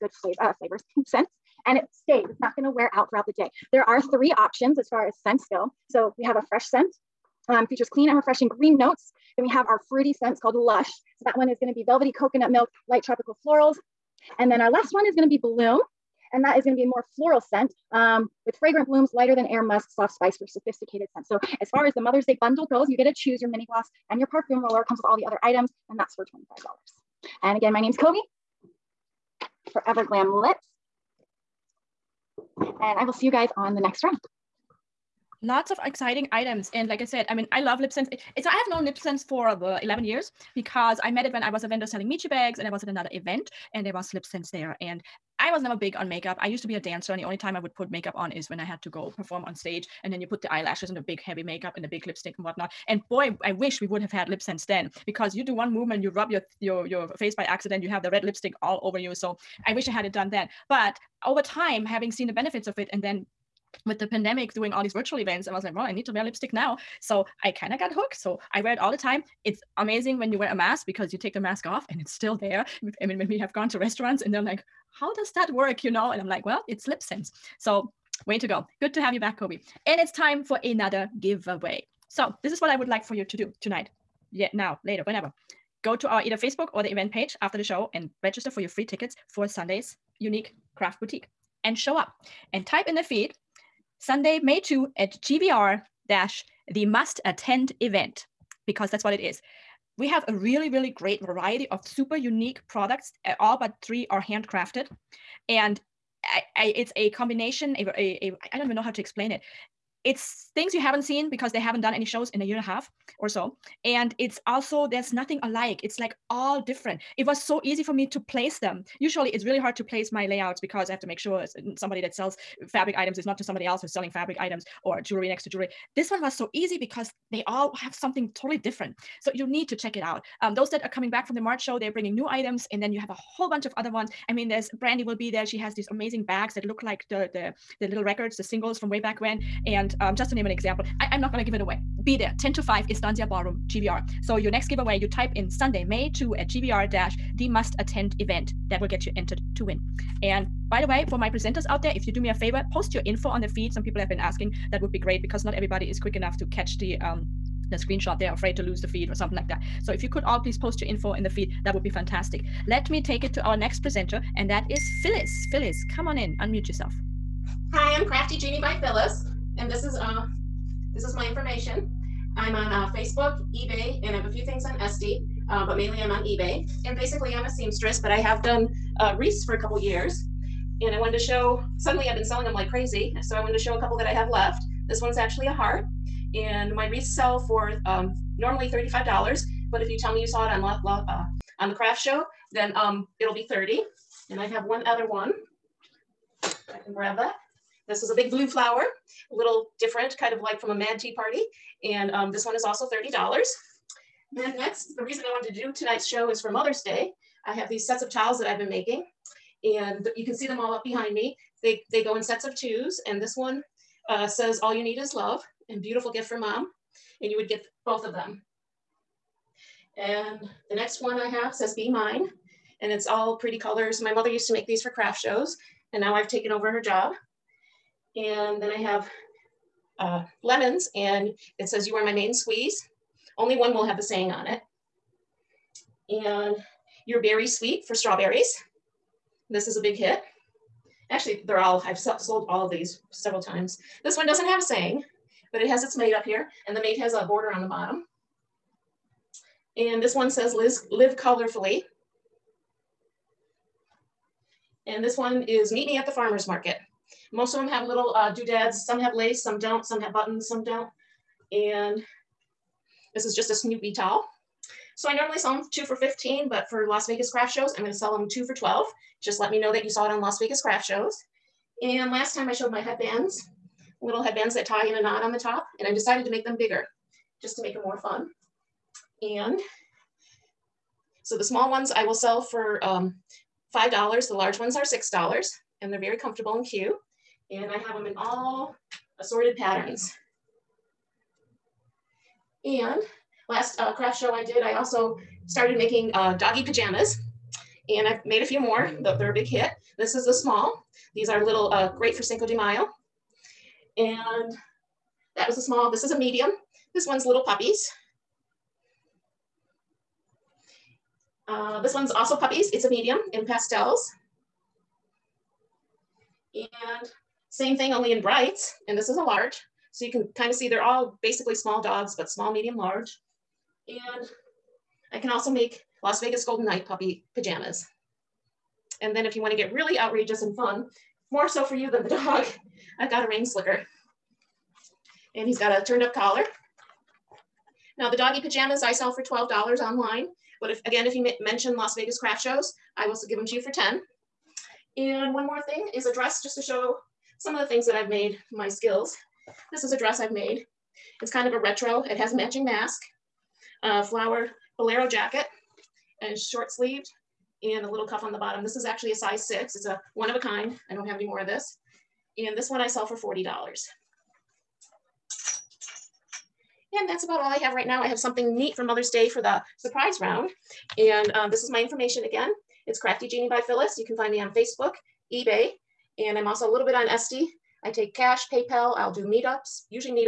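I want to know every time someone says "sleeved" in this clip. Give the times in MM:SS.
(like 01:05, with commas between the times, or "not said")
05:56.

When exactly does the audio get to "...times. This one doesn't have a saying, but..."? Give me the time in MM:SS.
04:03.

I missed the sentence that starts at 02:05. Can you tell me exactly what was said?
This one was so easy because they all have something totally different.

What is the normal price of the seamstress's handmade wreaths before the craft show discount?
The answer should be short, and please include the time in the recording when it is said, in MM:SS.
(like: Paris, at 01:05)
$35, at 03:08.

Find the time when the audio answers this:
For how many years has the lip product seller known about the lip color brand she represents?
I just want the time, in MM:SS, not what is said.
00:39.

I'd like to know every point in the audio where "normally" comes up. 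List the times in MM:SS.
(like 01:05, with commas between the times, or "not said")
03:08, 04:25.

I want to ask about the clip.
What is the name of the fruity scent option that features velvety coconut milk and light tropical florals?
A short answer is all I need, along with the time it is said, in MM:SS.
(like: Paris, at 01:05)
Lush, at 00:10.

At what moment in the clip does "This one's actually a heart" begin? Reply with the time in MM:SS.
03:04.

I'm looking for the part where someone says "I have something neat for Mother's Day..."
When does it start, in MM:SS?
06:08.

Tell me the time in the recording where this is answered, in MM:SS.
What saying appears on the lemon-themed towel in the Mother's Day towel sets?
03:51.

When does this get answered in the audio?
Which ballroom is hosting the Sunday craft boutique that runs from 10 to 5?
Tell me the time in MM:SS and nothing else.
02:22.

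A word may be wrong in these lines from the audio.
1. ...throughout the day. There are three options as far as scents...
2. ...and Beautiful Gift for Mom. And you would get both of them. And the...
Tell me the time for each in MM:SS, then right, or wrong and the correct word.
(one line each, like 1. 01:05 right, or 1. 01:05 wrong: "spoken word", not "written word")
1. 00:03 right
2. 03:35 right.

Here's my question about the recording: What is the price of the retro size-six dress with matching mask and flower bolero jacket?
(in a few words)
$40.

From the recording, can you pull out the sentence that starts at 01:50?
It's things you haven't seen because they haven't done any shows in a year and a half or so.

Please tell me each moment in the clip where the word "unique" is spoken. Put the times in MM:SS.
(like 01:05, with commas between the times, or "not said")
01:30, 01:42.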